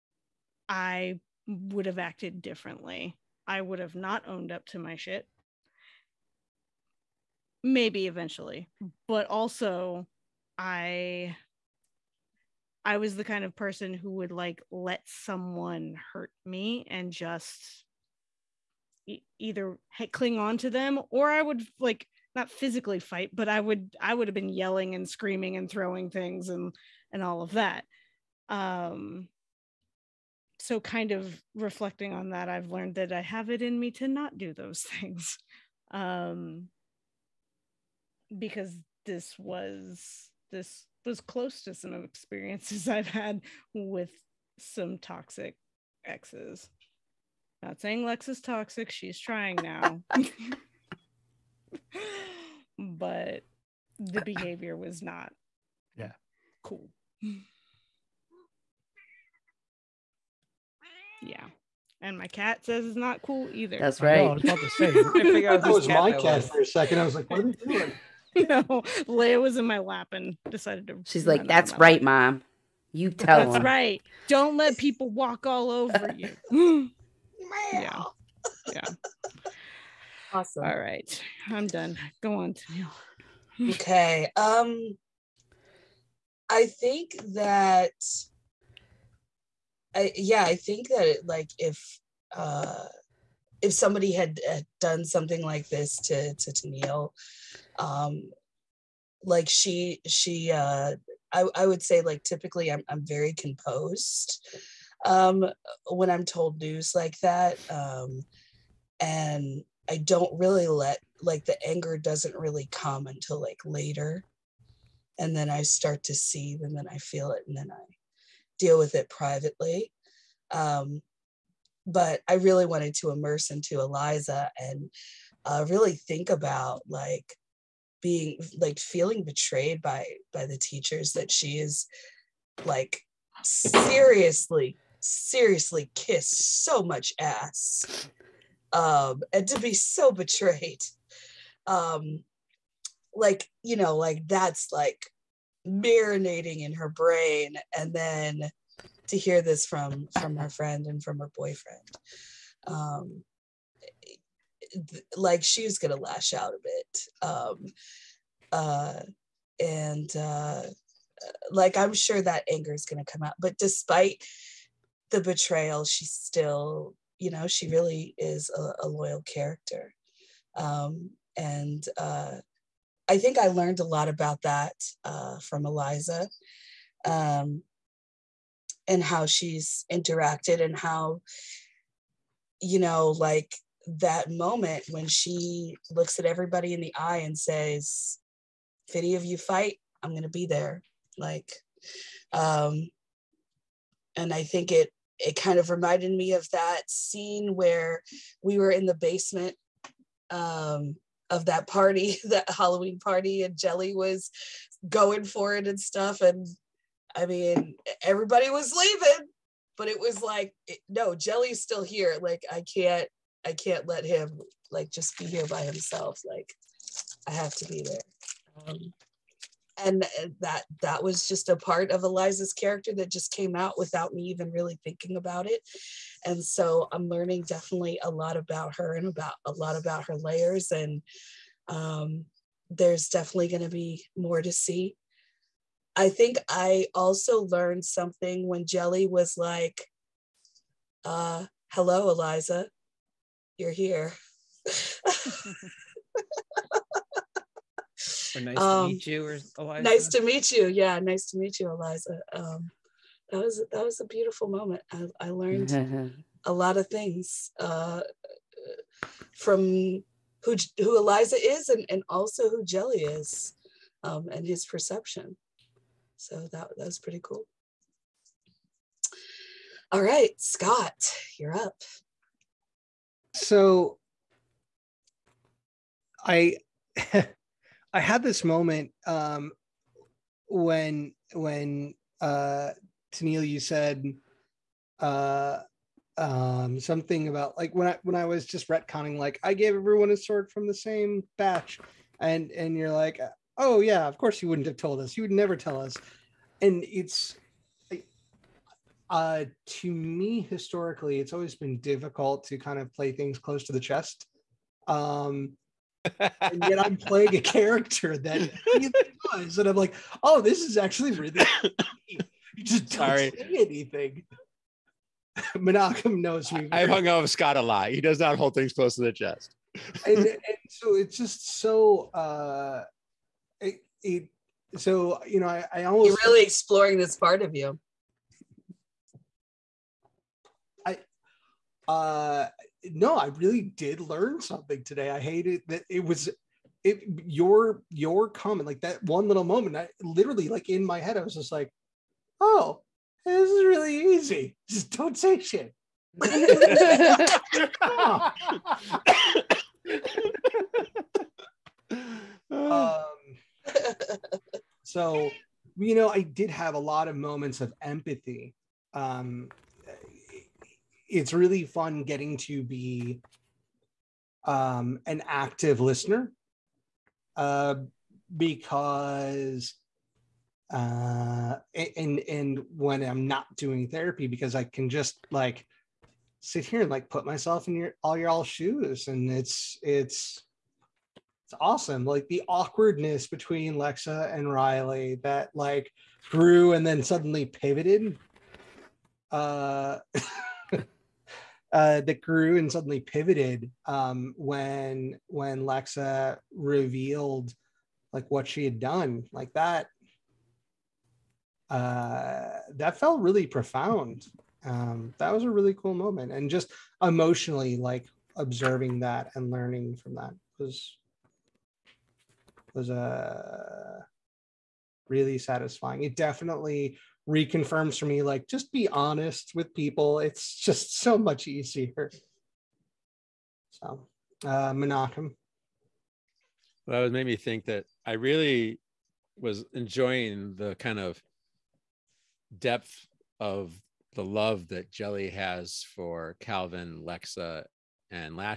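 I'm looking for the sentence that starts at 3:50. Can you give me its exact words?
And um, there's definitely going to be more to see.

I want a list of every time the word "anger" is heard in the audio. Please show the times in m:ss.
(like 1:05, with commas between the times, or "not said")
1:51, 2:42.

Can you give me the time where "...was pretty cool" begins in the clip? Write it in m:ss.
4:26.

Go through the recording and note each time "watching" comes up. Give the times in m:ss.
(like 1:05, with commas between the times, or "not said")
not said.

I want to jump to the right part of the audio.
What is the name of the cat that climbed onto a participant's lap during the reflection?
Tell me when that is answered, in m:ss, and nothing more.
1:09.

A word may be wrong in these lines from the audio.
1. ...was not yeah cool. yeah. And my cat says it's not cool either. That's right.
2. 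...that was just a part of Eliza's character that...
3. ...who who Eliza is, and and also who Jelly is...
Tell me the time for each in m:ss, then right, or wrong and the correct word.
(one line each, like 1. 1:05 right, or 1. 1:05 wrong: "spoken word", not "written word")
1. 0:54 right
2. 3:40 right
3. 4:20 right.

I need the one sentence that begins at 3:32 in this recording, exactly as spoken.
Like, I can't, I can't let him like just be here by himself.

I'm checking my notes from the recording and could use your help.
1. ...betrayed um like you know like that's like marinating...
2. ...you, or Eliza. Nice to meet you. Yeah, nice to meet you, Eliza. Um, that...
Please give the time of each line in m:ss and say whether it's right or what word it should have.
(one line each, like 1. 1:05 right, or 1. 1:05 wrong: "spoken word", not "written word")
1. 2:20 right
2. 4:09 right.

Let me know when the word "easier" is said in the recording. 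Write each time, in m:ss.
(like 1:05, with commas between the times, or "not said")
7:01.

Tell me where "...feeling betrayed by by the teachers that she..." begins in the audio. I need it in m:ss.
2:08.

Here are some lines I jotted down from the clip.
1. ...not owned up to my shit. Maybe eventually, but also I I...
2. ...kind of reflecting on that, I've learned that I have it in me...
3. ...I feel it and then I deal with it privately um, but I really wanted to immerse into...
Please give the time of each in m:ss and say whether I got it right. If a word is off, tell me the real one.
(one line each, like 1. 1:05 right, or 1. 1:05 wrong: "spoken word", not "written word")
1. 0:03 right
2. 0:30 right
3. 1:56 right.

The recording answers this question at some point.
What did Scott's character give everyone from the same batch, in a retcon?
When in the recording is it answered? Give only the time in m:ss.
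4:50.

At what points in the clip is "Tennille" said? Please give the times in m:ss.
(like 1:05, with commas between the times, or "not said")
1:36, 4:43.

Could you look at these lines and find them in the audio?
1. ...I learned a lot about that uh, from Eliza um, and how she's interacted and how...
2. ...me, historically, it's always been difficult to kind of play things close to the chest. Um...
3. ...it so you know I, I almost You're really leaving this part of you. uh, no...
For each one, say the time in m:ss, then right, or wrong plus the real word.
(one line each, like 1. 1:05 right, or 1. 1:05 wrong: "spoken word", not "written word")
1. 2:53 right
2. 4:59 right
3. 5:24 wrong: "exploring", not "leaving".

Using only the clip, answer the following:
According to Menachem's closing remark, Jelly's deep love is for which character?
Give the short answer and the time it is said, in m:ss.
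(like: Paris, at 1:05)
Calvin, at 7:16.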